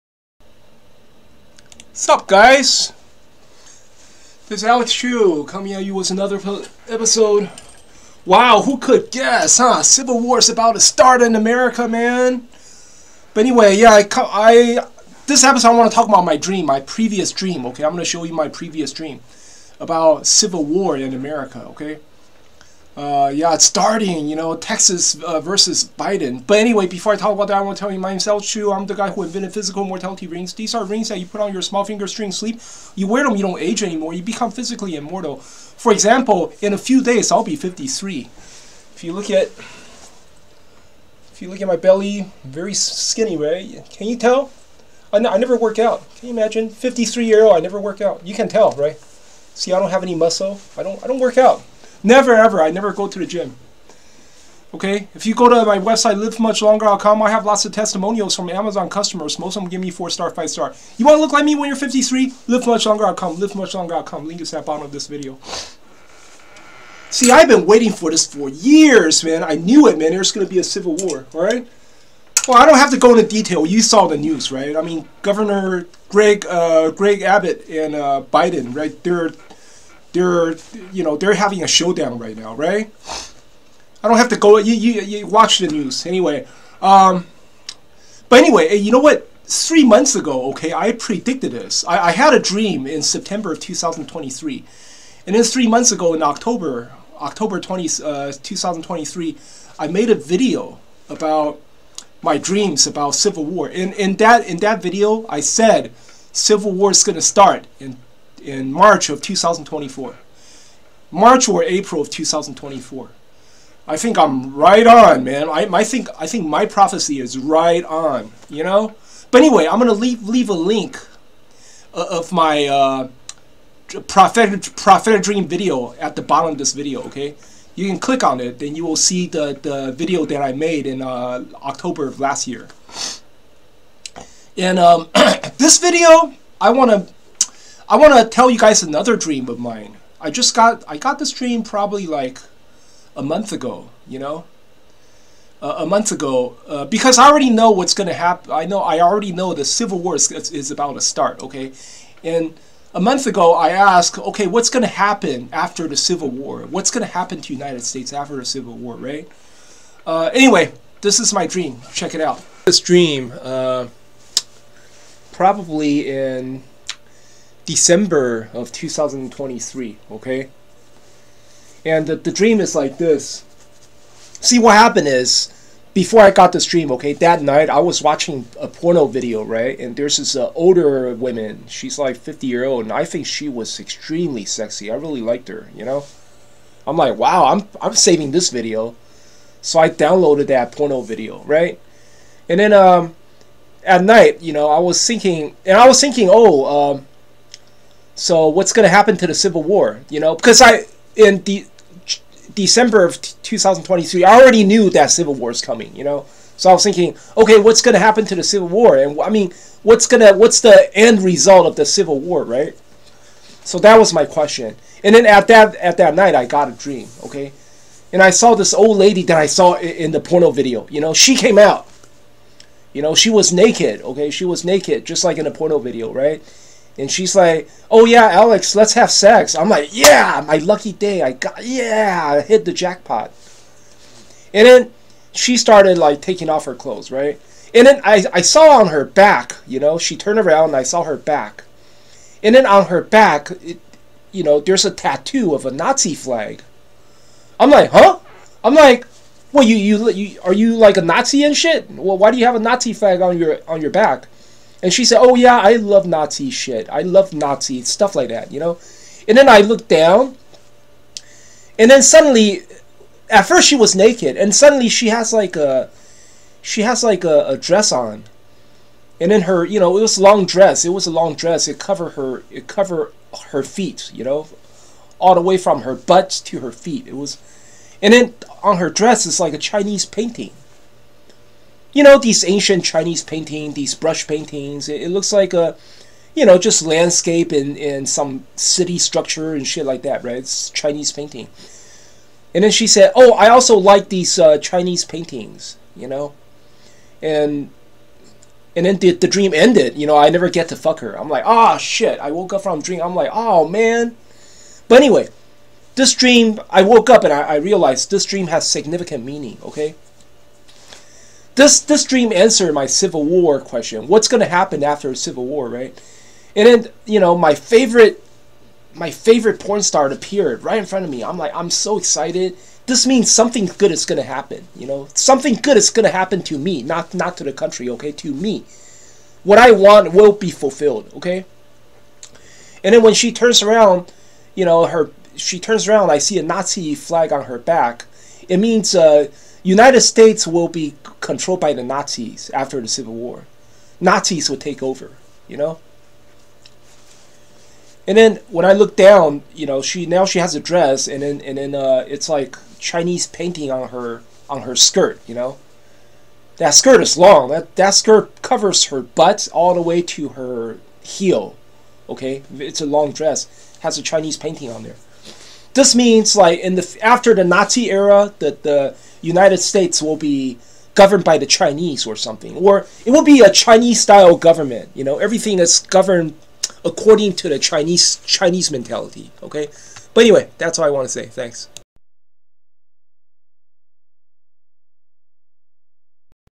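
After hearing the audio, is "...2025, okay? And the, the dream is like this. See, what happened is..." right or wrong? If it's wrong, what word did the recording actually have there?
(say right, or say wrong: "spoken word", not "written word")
wrong: "2023", not "2025".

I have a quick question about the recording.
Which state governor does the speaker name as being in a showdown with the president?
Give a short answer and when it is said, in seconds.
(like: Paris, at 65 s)
Greg Abbott, at 76 s.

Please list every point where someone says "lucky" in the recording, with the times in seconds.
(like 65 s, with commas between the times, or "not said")
230 s.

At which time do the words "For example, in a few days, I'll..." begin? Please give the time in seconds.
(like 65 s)
35 s.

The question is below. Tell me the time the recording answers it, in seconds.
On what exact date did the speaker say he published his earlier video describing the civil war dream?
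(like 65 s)
97 s.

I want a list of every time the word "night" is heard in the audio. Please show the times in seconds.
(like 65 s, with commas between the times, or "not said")
177 s, 194 s, 216 s.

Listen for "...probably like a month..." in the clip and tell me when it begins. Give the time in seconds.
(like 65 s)
141 s.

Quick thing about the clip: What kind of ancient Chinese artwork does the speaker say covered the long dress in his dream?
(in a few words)
brush paintings.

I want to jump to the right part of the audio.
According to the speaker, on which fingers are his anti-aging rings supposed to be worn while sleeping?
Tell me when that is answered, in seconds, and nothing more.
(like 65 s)
31 s.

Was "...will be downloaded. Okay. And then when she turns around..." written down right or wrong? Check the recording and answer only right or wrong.
wrong.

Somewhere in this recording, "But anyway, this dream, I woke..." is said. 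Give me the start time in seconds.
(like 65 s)
304 s.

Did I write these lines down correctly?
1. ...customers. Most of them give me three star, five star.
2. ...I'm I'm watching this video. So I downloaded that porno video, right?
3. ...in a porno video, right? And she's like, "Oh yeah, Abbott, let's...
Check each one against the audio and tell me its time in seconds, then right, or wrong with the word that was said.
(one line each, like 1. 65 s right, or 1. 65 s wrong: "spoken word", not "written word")
1. 58 s wrong: "four", not "three"
2. 187 s wrong: "saving", not "watching"
3. 225 s wrong: "Alex", not "Abbott".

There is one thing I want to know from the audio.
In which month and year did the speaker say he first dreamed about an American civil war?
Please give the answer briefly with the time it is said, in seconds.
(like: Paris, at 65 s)
September 2023, at 93 s.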